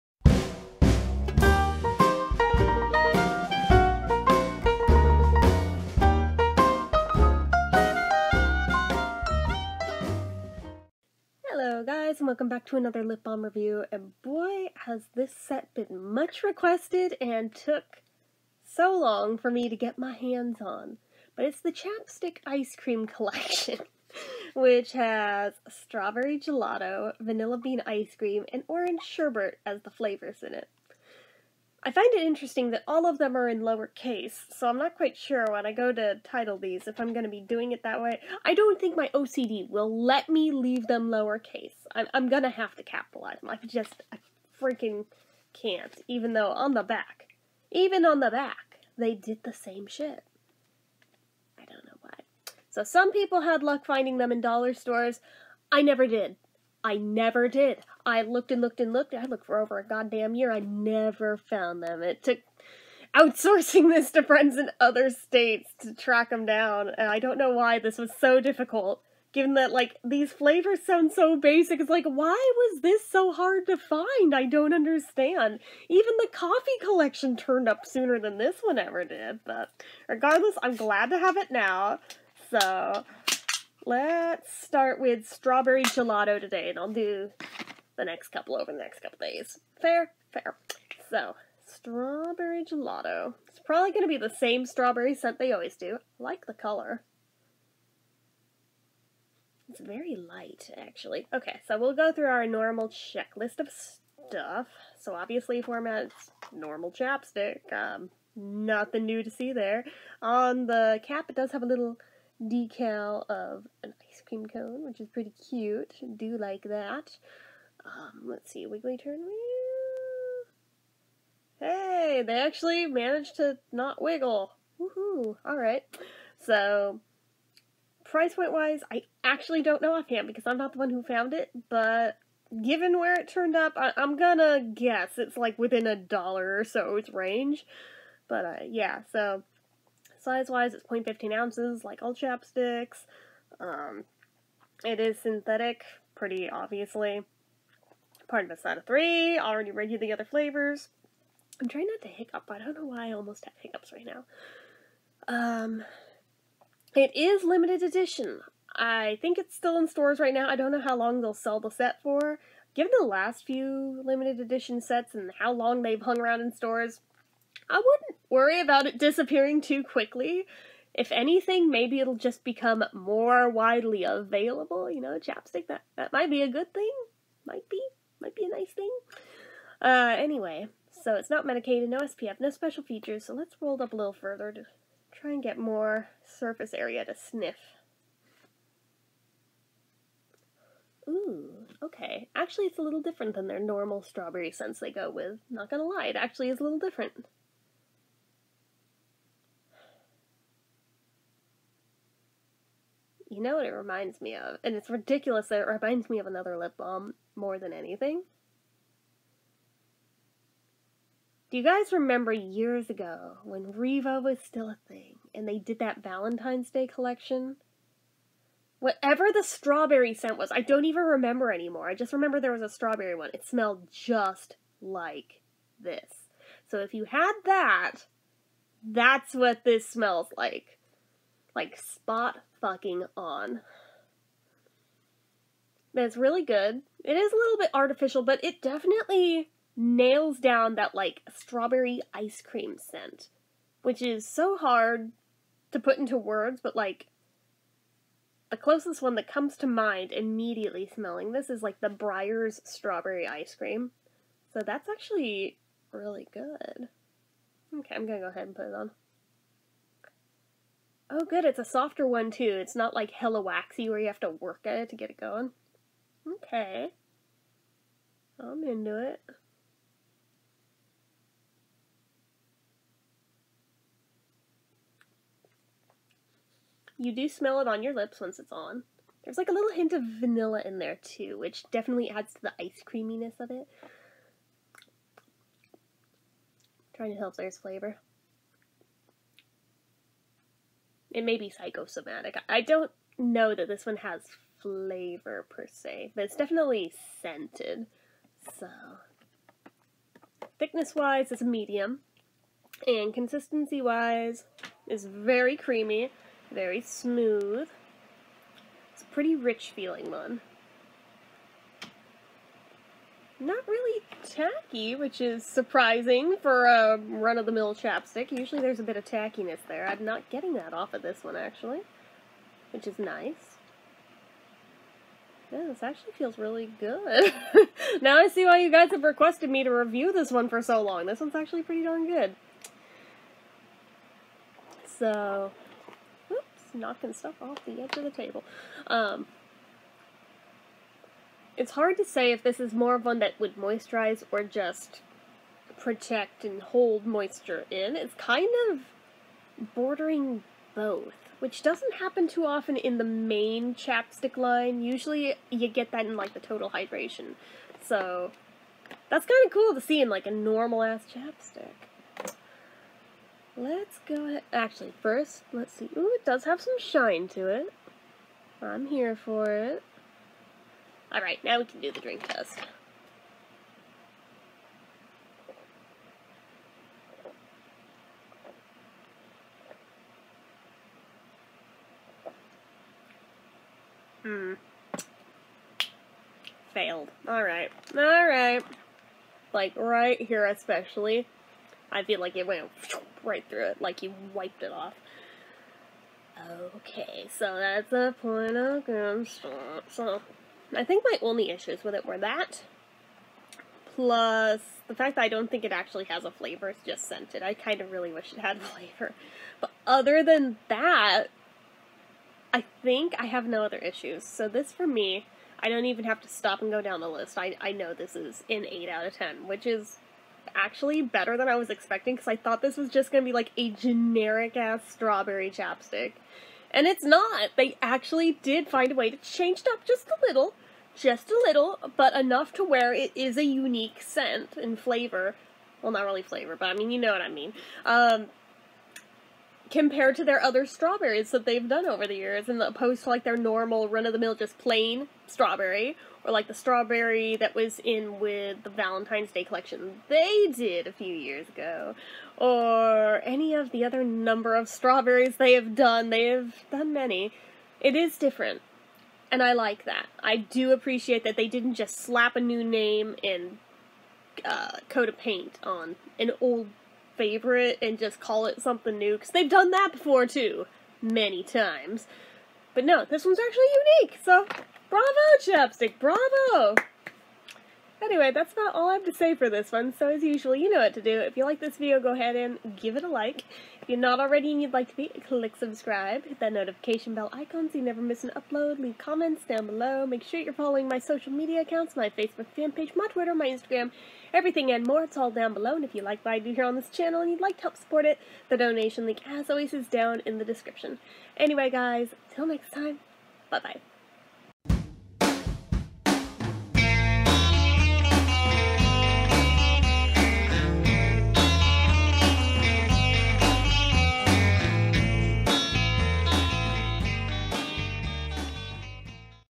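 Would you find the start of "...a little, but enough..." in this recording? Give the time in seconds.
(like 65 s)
431 s.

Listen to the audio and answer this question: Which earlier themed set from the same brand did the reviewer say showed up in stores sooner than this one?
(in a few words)
coffee collection.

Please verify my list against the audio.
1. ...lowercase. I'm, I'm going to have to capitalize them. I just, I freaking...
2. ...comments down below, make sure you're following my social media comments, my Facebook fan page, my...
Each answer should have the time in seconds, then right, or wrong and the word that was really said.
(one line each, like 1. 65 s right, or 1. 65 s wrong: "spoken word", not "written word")
1. 41 s right
2. 488 s wrong: "accounts", not "comments".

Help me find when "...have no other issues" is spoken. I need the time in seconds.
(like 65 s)
413 s.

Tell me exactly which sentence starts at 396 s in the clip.
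Okay, so that's a point of good start.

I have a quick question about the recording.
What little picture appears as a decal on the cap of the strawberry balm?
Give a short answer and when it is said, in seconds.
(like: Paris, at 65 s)
ice cream cone, at 114 s.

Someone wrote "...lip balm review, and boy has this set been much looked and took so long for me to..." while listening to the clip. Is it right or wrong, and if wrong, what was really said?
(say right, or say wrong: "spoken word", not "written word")
wrong: "requested", not "looked".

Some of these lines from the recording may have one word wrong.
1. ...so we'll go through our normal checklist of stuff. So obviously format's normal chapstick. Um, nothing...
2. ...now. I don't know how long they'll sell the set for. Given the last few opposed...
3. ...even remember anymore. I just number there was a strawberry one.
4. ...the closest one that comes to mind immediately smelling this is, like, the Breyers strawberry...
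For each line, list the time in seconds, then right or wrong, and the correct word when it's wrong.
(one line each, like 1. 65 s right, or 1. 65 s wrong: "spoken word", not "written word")
1. 101 s right
2. 160 s wrong: "limited", not "opposed"
3. 220 s wrong: "remember", not "number"
4. 248 s right.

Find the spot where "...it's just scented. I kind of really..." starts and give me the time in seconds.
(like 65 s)
406 s.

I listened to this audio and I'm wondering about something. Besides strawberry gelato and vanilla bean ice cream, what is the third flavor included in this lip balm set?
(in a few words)
orange sherbet.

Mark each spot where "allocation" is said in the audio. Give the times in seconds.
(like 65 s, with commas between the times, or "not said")
not said.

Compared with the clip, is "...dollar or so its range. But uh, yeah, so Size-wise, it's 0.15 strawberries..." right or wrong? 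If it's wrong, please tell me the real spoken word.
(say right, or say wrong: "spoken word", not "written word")
wrong: "ounces", not "strawberries".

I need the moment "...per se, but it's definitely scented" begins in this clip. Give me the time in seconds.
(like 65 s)
295 s.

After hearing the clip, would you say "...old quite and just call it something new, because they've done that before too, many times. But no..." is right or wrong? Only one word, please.
wrong.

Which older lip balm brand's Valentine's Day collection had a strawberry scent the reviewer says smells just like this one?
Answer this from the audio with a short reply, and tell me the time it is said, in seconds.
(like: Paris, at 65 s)
Revo, at 213 s.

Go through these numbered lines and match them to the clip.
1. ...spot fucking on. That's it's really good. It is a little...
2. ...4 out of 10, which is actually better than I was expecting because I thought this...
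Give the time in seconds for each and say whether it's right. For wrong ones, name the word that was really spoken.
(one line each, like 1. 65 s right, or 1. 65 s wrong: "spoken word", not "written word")
1. 231 s right
2. 418 s wrong: "8", not "4".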